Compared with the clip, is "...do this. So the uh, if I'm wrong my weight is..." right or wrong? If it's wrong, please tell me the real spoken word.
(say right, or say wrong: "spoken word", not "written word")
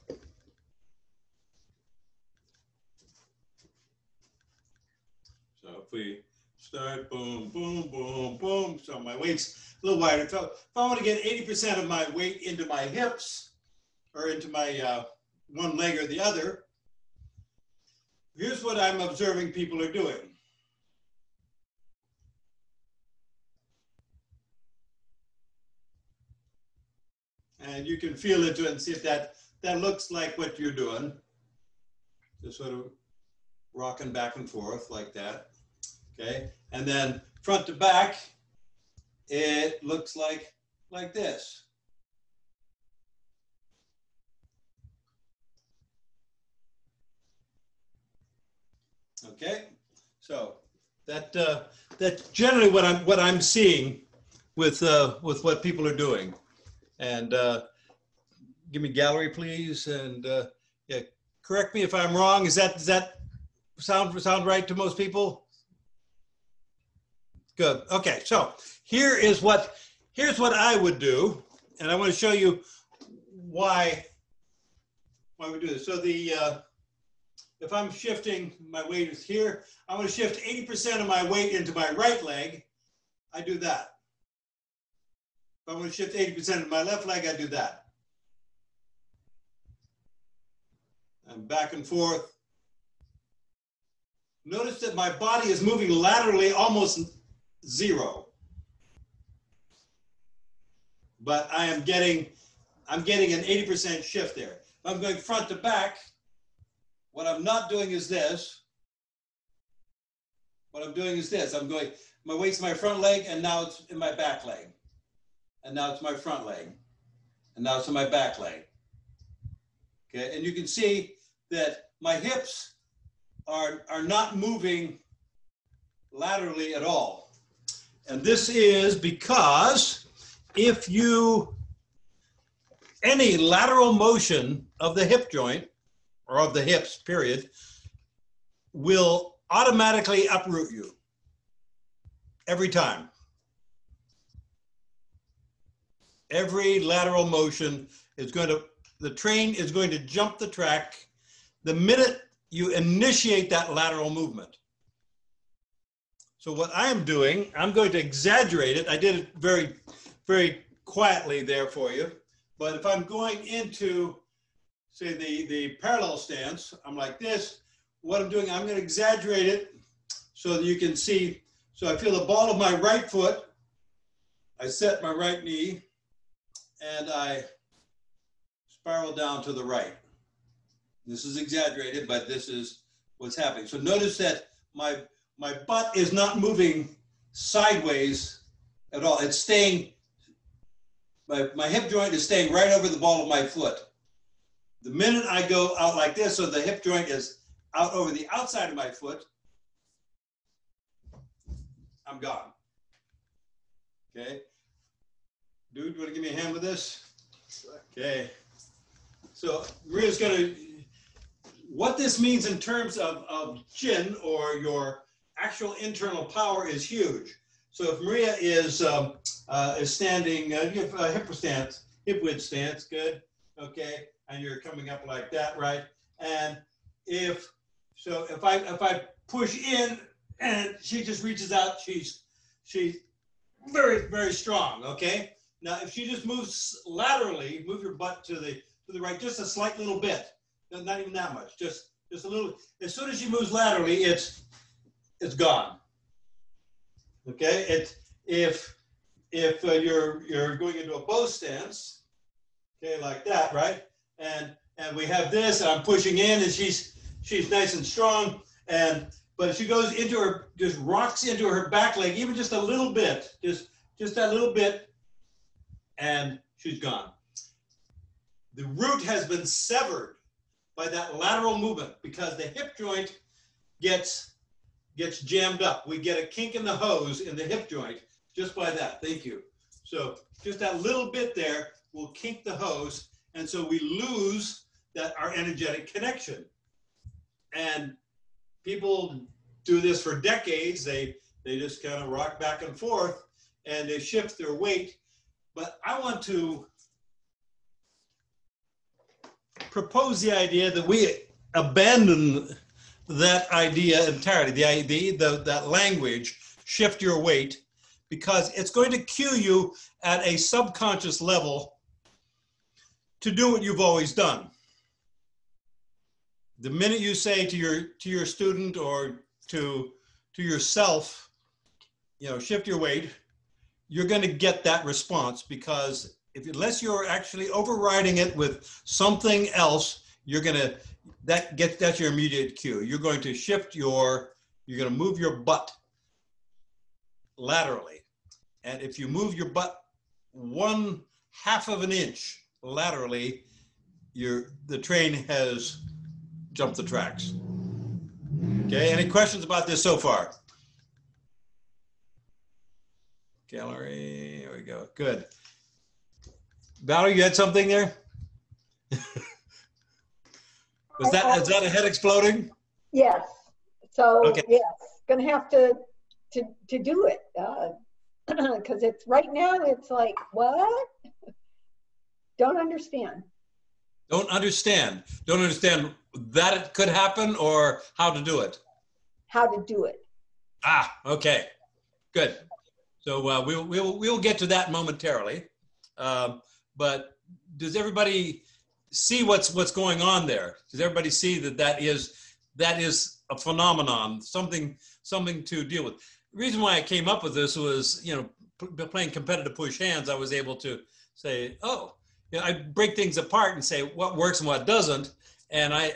wrong: "shifting", not "wrong".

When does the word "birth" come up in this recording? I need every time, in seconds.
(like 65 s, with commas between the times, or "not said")
not said.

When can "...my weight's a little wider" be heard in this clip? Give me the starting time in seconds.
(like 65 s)
8 s.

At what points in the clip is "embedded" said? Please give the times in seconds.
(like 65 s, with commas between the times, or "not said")
not said.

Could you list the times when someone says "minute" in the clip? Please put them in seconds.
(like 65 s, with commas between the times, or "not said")
151 s, 194 s, 316 s.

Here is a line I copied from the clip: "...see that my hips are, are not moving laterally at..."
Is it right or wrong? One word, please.
right.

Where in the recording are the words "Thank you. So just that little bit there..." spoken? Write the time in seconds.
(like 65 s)
279 s.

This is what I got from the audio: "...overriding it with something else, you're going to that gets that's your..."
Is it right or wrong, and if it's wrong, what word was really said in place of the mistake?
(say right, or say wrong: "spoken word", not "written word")
right.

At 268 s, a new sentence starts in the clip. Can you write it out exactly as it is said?
The root has been severed by that lateral movement because the hip joint gets gets jammed up.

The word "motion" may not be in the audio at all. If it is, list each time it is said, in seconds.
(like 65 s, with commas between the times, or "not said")
133 s, 147 s.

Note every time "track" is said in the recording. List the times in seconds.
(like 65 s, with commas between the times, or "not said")
150 s, 346 s.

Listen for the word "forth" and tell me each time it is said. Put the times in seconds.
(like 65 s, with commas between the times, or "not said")
34 s, 91 s, 292 s.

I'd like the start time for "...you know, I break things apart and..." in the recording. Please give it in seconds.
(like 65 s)
402 s.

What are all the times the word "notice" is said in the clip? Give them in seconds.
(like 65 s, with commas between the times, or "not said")
94 s, 183 s.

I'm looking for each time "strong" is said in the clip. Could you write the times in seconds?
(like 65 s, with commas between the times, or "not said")
234 s, 257 s.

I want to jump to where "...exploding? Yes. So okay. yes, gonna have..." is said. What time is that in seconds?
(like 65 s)
361 s.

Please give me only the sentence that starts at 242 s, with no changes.
As soon as she moves laterally, it's it's gone.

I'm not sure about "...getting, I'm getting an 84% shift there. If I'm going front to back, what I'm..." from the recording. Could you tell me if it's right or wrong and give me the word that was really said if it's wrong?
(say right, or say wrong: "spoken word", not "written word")
wrong: "80", not "84".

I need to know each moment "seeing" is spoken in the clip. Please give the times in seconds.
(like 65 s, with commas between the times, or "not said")
53 s.